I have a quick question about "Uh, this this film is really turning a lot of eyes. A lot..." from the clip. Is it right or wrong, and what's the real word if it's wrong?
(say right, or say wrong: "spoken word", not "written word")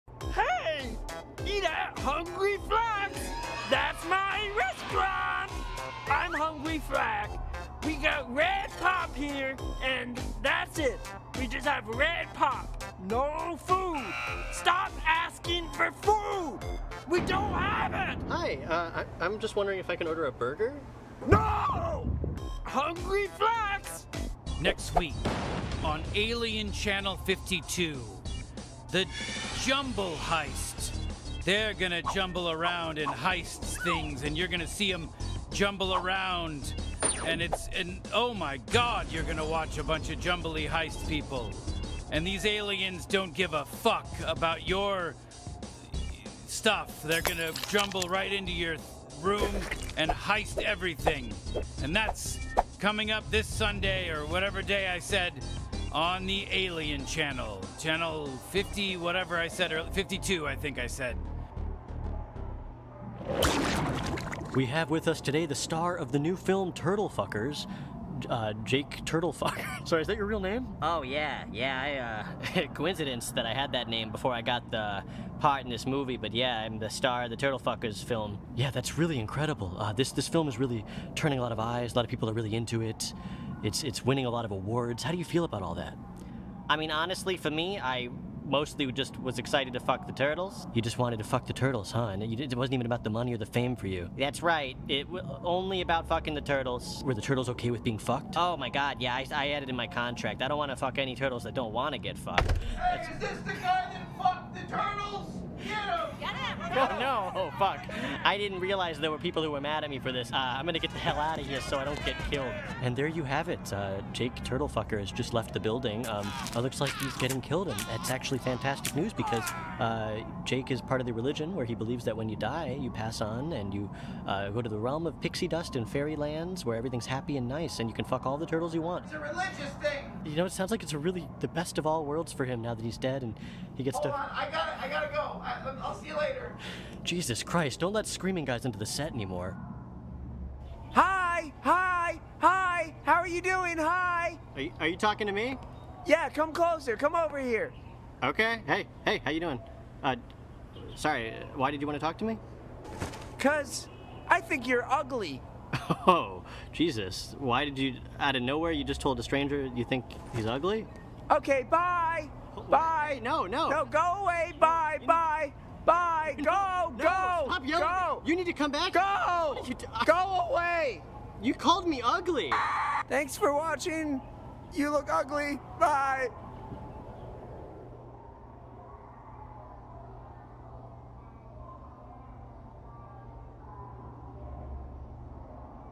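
right.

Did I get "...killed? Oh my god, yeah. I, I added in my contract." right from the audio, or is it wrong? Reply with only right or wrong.
wrong.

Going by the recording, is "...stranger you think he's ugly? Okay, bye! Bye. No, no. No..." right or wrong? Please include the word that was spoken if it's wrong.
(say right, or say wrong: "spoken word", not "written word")
right.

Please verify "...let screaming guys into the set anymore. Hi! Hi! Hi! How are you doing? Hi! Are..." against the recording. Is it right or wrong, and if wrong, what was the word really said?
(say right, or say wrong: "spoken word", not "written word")
right.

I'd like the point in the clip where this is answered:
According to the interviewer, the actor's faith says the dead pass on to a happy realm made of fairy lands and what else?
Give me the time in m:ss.
2:05.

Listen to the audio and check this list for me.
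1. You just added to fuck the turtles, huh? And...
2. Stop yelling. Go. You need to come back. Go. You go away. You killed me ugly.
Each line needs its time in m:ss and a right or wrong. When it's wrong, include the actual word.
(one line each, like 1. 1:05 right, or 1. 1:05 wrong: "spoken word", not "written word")
1. 1:30 wrong: "wanted", not "added"
2. 2:47 wrong: "called", not "killed".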